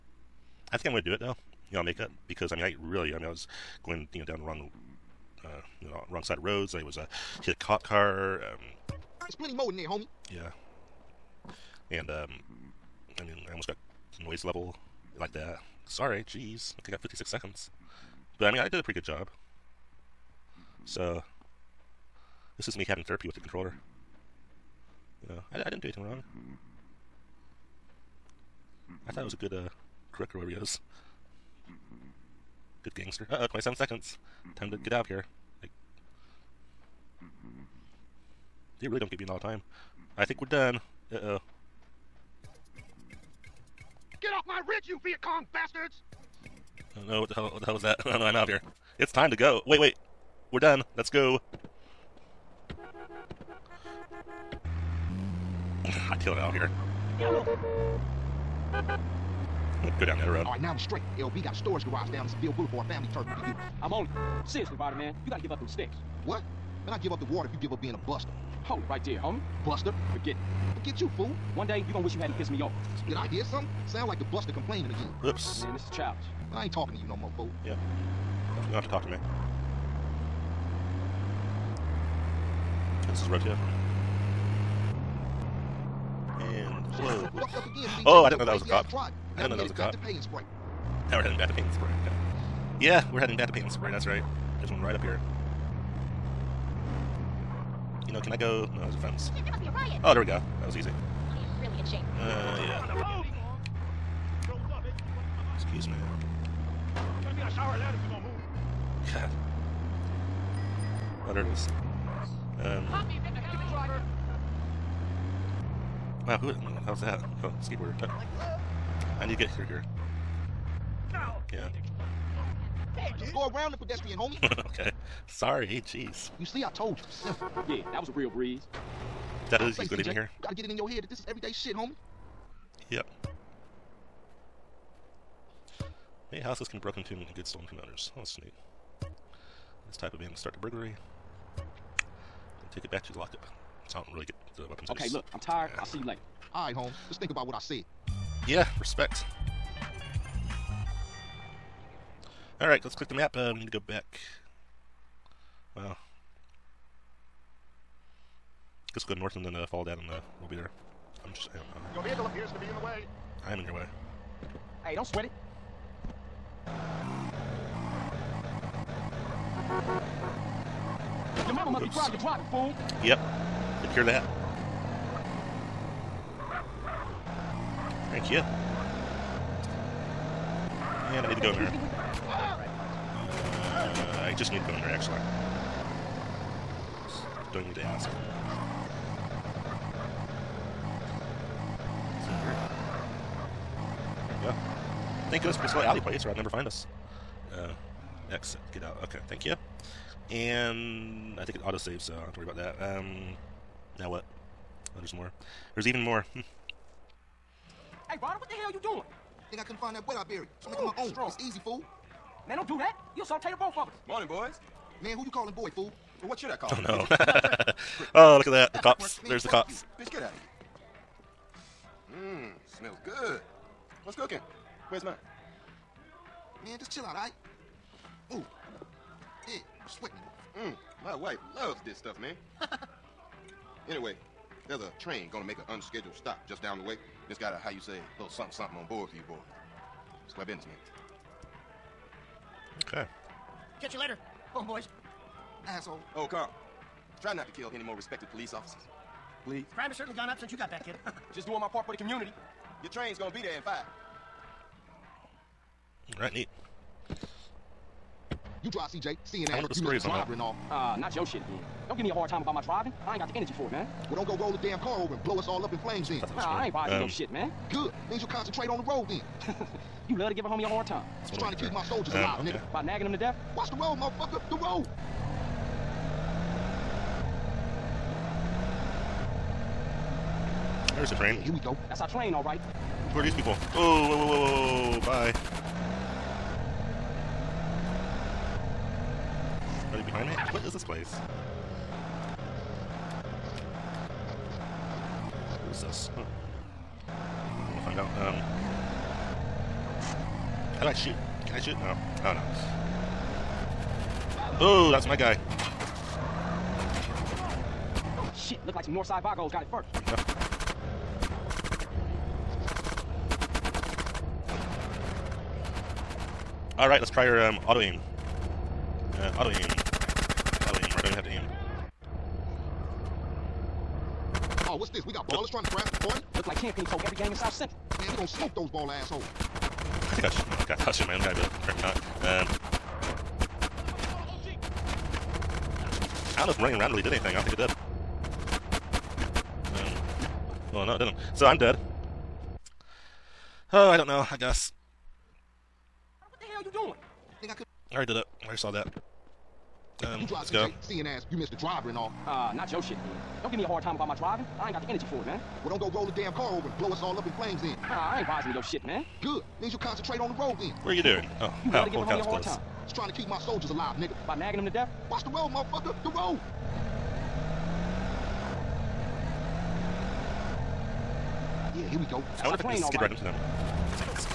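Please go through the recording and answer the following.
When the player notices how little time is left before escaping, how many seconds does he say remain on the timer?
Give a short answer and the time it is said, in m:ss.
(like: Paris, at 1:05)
27, at 0:33.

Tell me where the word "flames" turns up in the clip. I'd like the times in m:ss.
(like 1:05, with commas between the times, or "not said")
4:25, 5:57.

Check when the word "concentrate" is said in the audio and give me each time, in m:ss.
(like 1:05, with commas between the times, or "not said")
4:28, 5:59.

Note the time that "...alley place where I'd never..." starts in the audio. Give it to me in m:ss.
3:15.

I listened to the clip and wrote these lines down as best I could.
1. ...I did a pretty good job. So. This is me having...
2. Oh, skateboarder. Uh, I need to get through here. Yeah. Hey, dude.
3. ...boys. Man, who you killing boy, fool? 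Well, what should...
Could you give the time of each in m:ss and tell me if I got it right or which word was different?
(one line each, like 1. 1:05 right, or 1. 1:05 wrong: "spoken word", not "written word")
1. 0:18 right
2. 1:57 right
3. 3:34 wrong: "calling", not "killing".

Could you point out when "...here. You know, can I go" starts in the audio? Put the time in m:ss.
1:35.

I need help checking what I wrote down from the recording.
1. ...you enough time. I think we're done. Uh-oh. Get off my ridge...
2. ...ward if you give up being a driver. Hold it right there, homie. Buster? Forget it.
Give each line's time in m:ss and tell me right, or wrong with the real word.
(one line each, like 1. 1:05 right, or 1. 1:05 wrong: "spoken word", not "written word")
1. 0:39 right
2. 1:07 wrong: "buster", not "driver".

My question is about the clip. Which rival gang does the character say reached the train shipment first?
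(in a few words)
Northside Vagos.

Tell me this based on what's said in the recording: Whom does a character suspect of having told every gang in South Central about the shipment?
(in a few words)
Tenpenny.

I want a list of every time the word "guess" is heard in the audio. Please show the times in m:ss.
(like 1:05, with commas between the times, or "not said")
2:38, 5:44.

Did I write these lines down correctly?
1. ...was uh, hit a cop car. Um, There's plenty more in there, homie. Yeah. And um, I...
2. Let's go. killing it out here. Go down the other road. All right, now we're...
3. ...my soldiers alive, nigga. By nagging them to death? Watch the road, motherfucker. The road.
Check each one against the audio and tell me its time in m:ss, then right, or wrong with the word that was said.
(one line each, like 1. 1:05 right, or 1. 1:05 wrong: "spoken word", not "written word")
1. 0:06 right
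2. 0:50 right
3. 6:03 right.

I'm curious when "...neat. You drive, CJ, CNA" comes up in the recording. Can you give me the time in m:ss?
4:16.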